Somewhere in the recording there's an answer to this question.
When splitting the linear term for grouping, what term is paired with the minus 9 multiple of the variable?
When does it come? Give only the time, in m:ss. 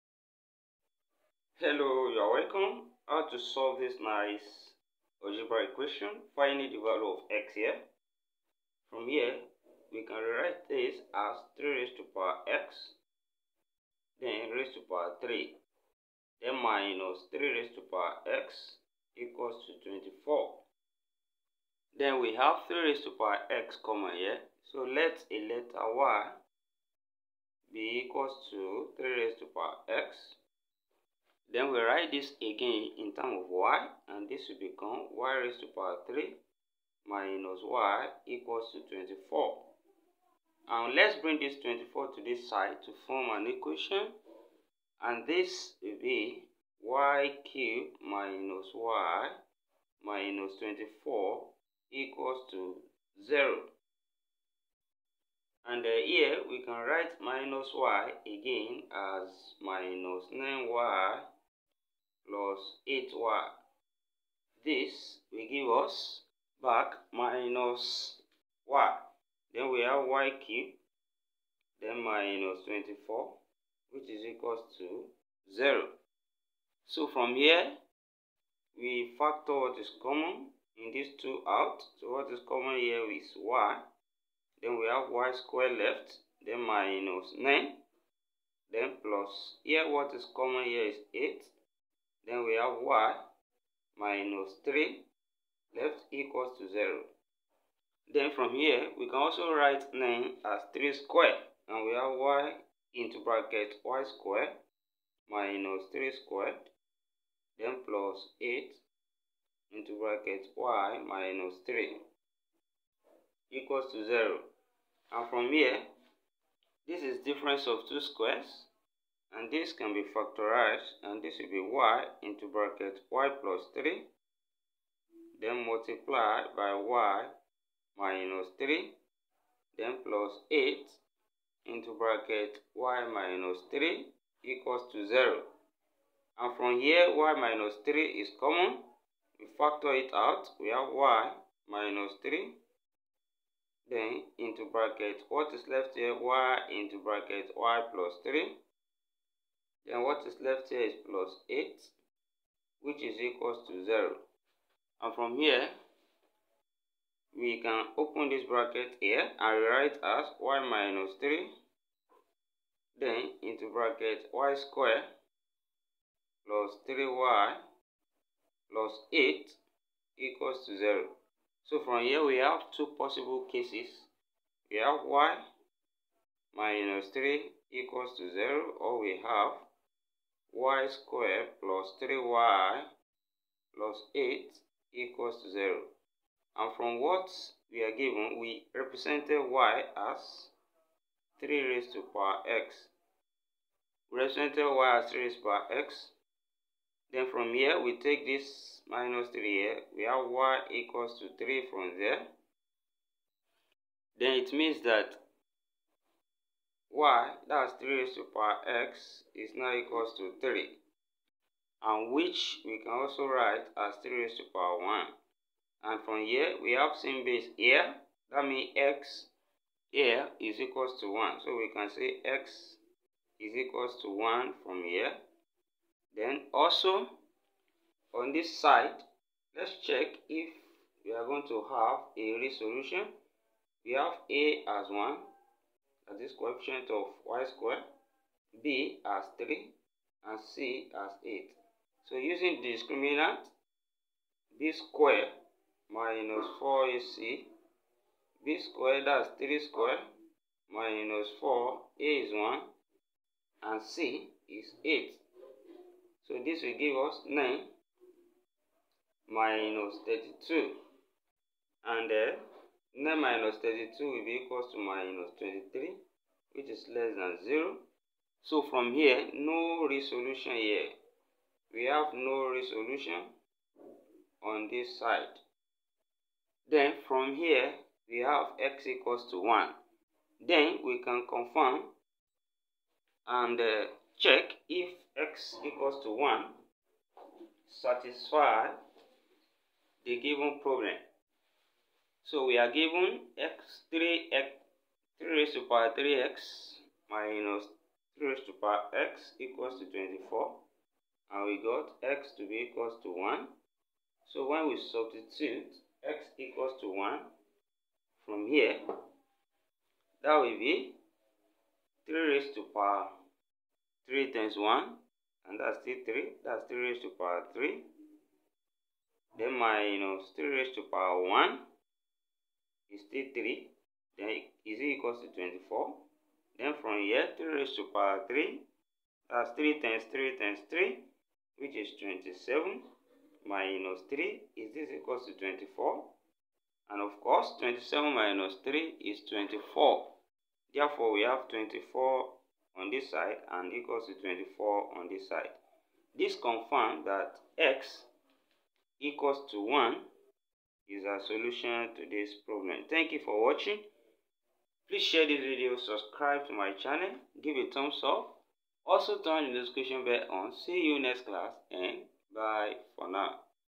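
1:02.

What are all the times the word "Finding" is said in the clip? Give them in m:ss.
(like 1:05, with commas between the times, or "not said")
0:06.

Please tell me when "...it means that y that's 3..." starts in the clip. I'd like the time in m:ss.
3:24.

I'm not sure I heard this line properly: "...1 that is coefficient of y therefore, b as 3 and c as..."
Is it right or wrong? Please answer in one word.
wrong.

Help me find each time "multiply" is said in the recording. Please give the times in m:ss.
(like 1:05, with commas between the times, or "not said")
2:05.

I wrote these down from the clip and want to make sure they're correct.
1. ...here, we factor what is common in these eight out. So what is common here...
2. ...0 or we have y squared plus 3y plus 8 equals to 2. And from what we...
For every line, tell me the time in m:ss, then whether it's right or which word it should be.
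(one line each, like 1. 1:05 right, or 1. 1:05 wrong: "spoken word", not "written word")
1. 1:17 wrong: "two", not "eight"
2. 2:58 wrong: "0", not "2".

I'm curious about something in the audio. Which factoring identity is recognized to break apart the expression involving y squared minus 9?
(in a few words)
difference of two squares.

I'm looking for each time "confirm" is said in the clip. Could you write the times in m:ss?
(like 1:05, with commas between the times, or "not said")
4:41, 5:46.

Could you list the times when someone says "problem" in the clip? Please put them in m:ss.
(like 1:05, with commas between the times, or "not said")
4:50, 5:52.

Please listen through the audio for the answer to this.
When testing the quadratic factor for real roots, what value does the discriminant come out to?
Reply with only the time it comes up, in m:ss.
4:24.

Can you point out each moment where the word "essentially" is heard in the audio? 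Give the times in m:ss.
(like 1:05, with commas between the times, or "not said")
not said.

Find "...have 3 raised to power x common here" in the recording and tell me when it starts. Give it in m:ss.
0:22.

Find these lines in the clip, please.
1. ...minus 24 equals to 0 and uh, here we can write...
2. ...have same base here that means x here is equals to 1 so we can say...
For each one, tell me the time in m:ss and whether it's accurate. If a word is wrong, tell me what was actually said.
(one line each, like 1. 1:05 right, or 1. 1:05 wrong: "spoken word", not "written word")
1. 0:50 right
2. 3:36 right.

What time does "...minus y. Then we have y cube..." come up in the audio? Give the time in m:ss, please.
1:07.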